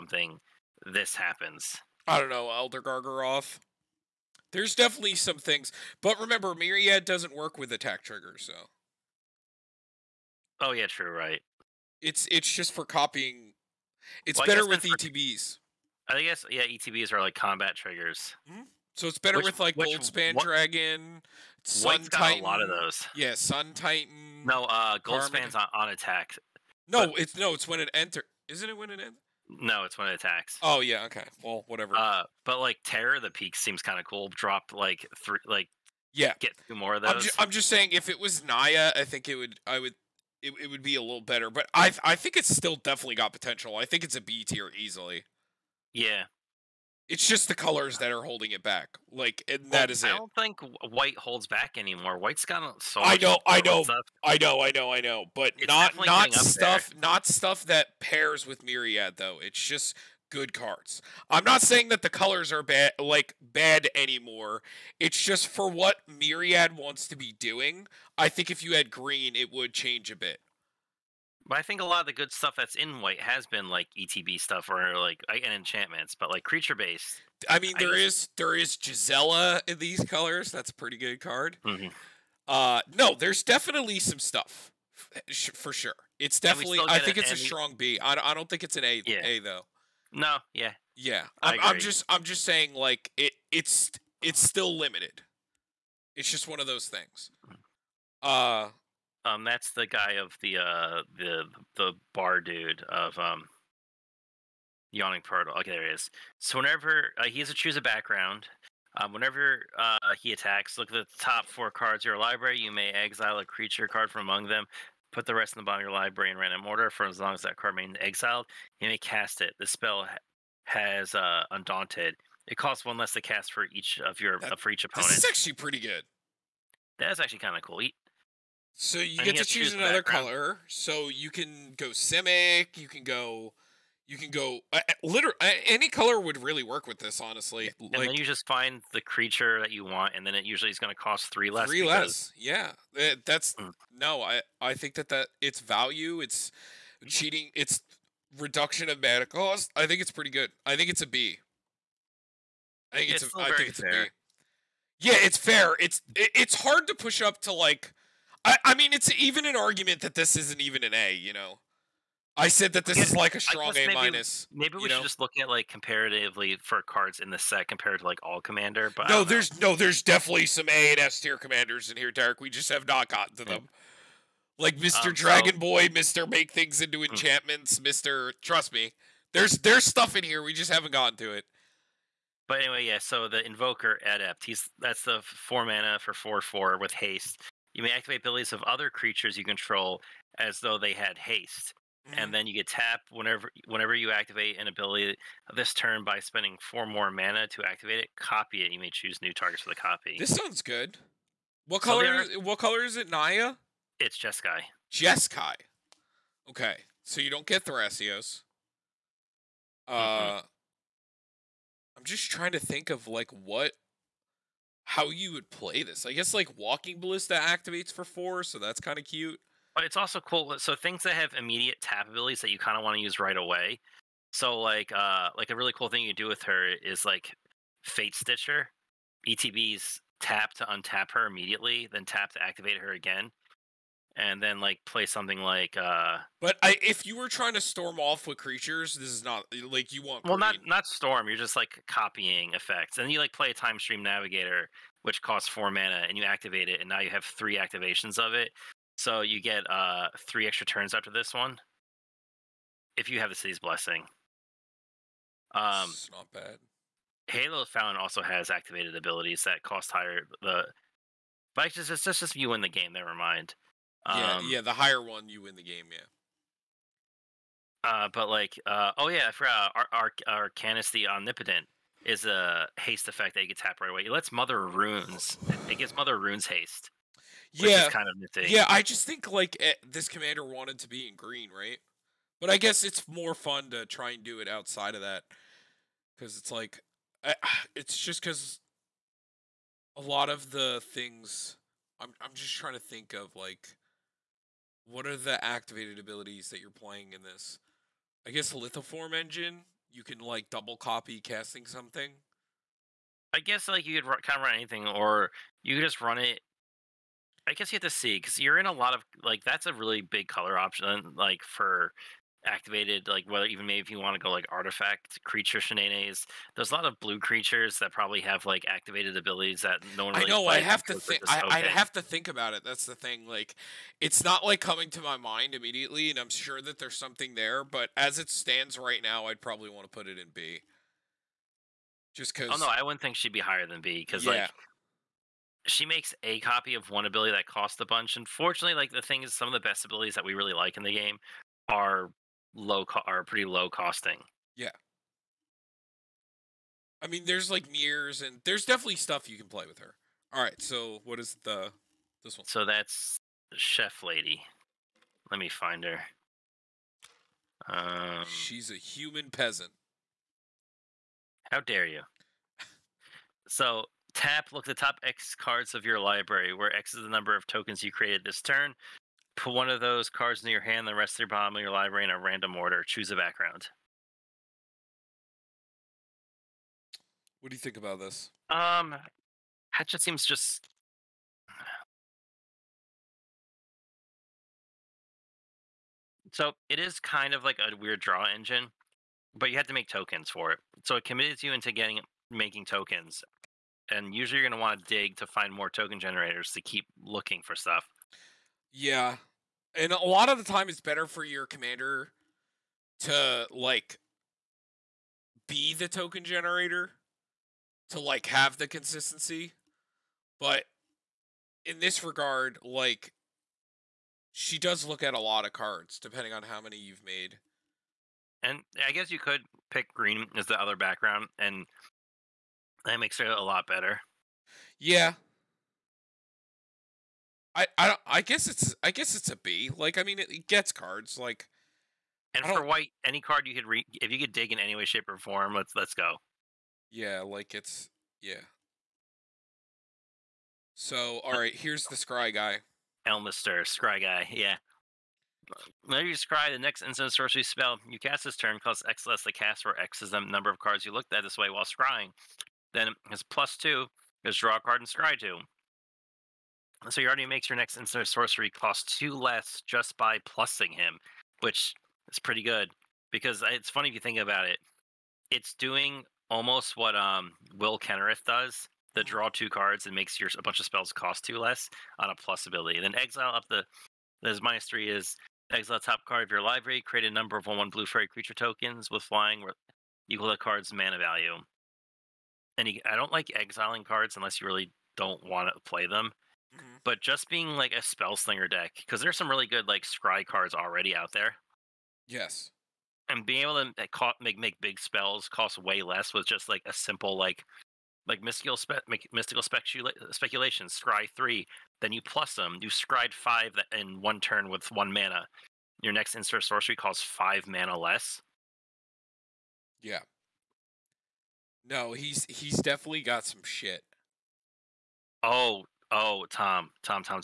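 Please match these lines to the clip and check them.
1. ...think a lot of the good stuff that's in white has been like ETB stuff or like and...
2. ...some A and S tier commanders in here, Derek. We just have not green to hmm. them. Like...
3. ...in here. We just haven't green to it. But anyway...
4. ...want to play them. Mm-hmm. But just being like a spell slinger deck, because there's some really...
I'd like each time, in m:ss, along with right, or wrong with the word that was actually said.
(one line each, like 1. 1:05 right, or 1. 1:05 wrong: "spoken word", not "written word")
1. 1:11 right
2. 2:50 wrong: "gotten", not "green"
3. 3:00 wrong: "gotten", not "green"
4. 8:05 right.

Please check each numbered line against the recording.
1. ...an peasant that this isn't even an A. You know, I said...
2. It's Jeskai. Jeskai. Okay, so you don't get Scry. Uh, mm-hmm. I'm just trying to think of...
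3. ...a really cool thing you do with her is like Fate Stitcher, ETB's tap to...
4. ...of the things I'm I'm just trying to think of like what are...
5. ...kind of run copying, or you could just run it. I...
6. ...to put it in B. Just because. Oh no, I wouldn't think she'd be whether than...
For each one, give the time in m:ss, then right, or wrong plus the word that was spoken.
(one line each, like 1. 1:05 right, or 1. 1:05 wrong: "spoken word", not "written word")
1. 2:39 wrong: "argument", not "peasant"
2. 3:23 wrong: "Thrasios", not "Scry"
3. 3:45 right
4. 4:50 right
5. 5:04 wrong: "anything", not "copying"
6. 5:29 wrong: "higher", not "whether".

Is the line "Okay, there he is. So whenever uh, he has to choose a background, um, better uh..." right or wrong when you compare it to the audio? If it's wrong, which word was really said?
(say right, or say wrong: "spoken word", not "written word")
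wrong: "whenever", not "better".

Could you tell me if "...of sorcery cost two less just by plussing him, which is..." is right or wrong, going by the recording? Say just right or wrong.
right.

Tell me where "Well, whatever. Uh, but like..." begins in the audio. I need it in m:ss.
0:31.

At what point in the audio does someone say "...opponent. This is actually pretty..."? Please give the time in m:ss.
2:04.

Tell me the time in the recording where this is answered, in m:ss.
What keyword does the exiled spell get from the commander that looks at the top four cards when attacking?
2:01.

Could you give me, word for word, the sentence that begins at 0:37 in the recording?
I'm, ju- I'm just saying, if it was Naya, I think it would.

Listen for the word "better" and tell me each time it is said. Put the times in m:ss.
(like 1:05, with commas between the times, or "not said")
0:14, 0:19, 0:41, 6:40, 7:03.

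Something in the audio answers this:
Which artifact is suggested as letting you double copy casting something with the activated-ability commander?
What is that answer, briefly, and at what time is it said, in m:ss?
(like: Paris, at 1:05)
Lithoform Engine, at 4:58.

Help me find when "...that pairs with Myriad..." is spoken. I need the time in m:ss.
0:57.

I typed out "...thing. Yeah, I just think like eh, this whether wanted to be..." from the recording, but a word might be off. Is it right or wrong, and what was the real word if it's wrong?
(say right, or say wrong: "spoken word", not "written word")
wrong: "commander", not "whether".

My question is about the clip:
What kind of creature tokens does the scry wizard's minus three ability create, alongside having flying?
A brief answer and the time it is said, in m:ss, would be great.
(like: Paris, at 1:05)
Blue fairy, at 7:57.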